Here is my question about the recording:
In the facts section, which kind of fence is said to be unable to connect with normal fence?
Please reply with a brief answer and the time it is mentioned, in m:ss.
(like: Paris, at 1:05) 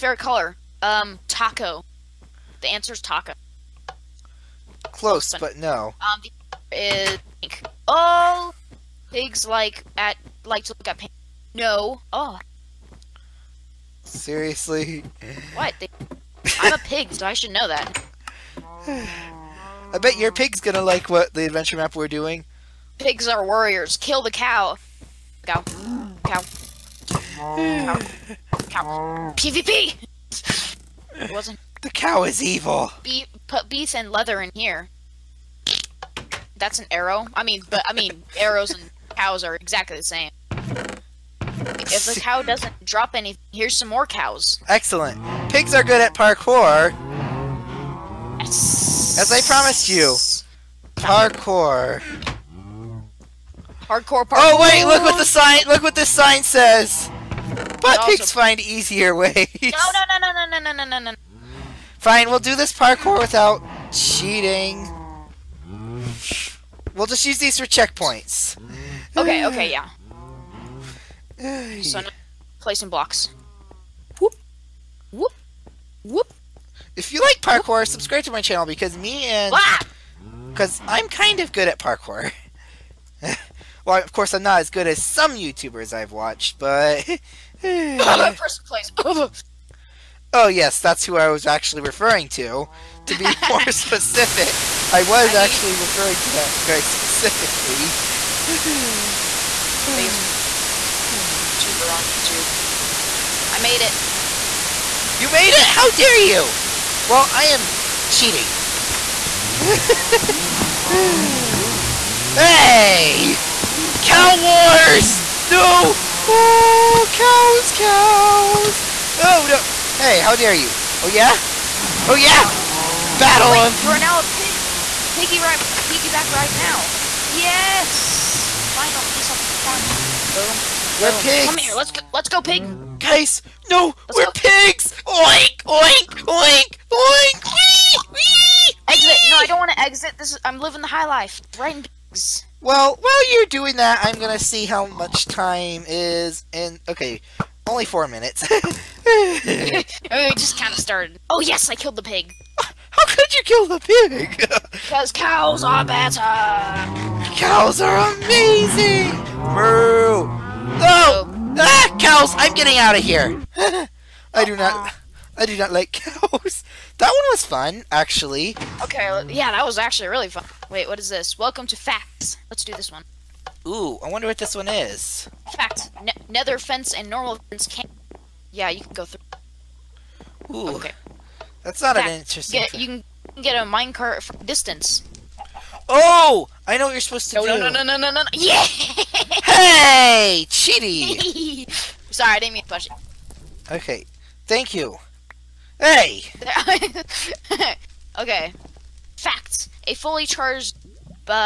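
Nether fence, at 2:56.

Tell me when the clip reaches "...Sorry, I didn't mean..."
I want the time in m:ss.
3:12.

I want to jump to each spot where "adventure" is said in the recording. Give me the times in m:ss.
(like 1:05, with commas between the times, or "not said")
0:21.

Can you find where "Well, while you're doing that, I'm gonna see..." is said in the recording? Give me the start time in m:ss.
2:22.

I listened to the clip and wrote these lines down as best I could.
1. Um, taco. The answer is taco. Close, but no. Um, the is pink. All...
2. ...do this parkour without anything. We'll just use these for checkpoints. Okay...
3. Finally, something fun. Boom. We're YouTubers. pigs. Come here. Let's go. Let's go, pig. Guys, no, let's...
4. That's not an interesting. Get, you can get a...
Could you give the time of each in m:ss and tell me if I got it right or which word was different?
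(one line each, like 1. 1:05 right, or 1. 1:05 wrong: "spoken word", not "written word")
1. 0:00 right
2. 1:02 wrong: "cheating", not "anything"
3. 2:08 wrong: "Boom", not "YouTubers"
4. 3:01 right.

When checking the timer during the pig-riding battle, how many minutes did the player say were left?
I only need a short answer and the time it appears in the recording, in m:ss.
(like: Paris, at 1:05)
4, at 2:27.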